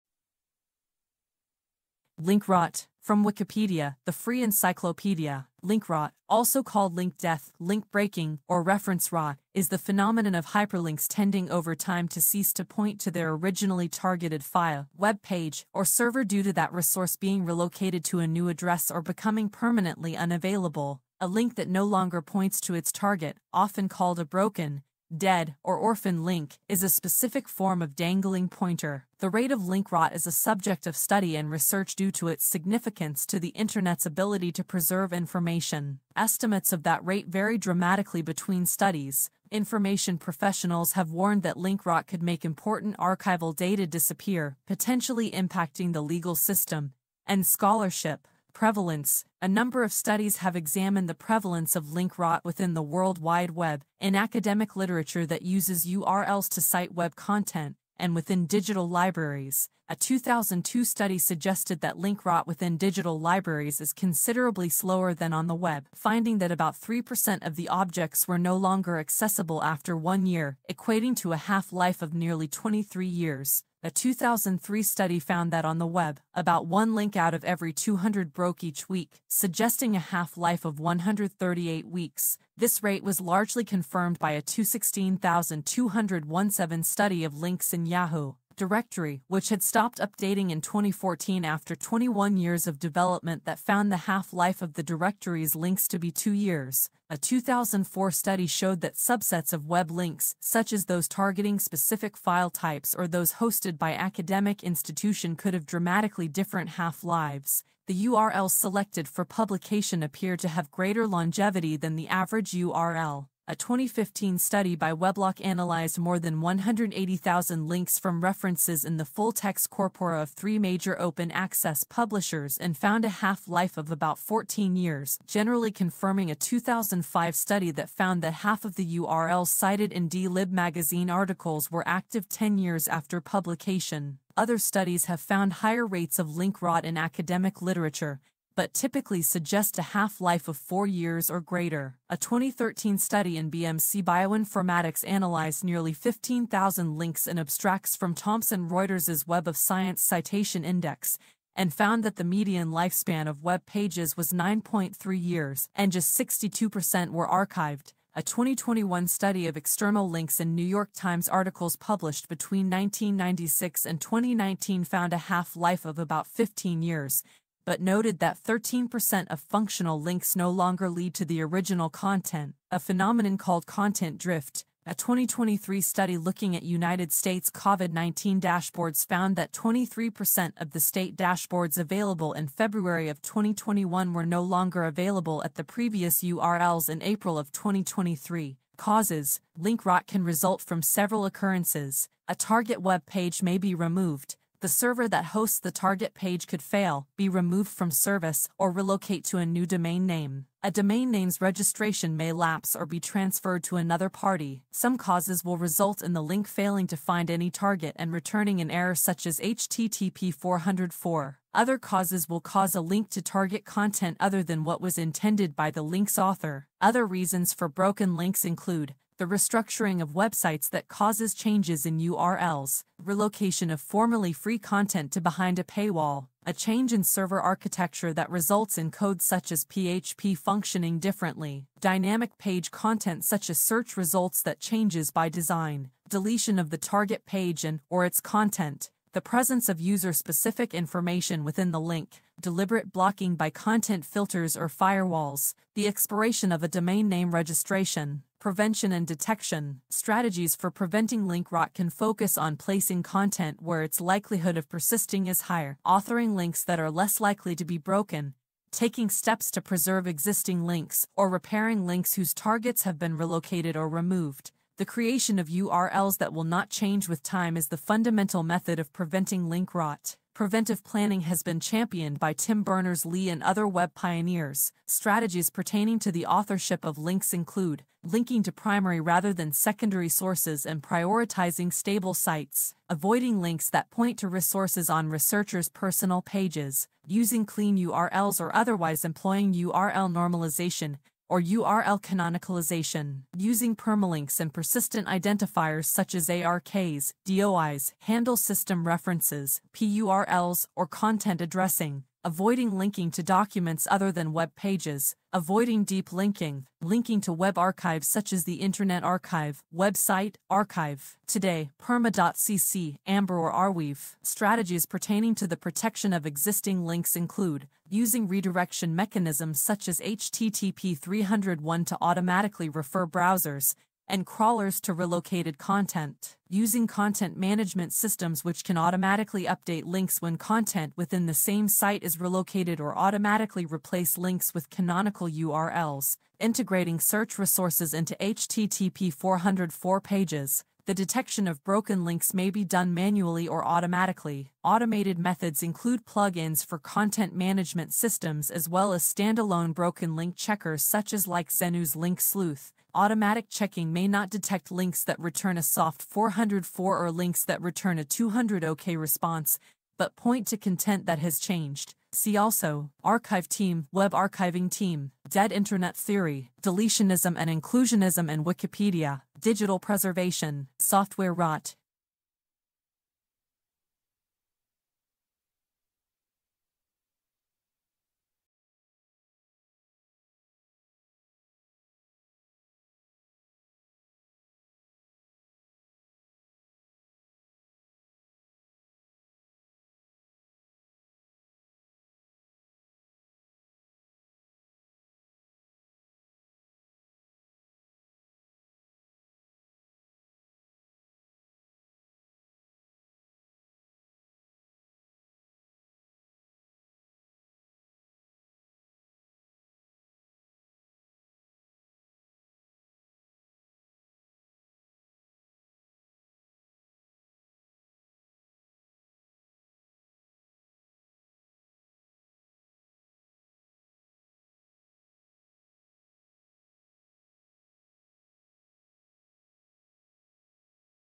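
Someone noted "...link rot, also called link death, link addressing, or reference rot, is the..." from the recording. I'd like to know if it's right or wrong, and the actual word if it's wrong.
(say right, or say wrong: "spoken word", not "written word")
wrong: "breaking", not "addressing".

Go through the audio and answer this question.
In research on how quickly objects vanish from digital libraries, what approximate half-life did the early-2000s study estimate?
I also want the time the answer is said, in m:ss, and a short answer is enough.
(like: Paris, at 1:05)
nearly 23 years, at 1:12.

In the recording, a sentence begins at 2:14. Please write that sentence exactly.
Other studies have found higher rates of link rot in academic literature, but typically suggest a half-life of four years or greater.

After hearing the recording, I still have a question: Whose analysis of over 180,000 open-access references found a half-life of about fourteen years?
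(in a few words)
Weblock.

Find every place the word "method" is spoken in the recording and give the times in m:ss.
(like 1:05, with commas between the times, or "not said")
4:28, 5:45.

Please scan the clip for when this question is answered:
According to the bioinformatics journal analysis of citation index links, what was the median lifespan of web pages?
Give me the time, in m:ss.
2:34.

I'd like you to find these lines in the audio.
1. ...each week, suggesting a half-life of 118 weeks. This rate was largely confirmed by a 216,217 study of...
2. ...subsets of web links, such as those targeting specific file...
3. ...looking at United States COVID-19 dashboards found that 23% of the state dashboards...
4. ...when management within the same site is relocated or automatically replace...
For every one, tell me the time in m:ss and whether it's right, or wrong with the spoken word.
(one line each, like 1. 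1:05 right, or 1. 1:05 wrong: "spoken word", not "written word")
1. 1:18 wrong: "138", not "118"
2. 1:38 right
3. 2:56 right
4. 5:30 wrong: "content", not "management".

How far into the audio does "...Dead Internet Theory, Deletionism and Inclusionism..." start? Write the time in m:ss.
6:05.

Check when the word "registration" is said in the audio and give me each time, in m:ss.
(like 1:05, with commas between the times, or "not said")
3:21, 4:07.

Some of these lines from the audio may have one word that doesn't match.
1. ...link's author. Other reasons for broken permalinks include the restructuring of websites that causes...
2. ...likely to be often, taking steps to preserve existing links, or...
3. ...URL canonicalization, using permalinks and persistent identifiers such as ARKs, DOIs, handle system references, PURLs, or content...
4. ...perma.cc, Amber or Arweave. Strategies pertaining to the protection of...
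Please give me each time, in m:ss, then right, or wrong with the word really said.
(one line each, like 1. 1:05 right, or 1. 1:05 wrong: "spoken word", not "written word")
1. 3:35 wrong: "links", not "permalinks"
2. 4:17 wrong: "broken", not "often"
3. 4:51 right
4. 5:11 right.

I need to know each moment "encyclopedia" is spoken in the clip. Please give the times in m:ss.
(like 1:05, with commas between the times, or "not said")
0:04.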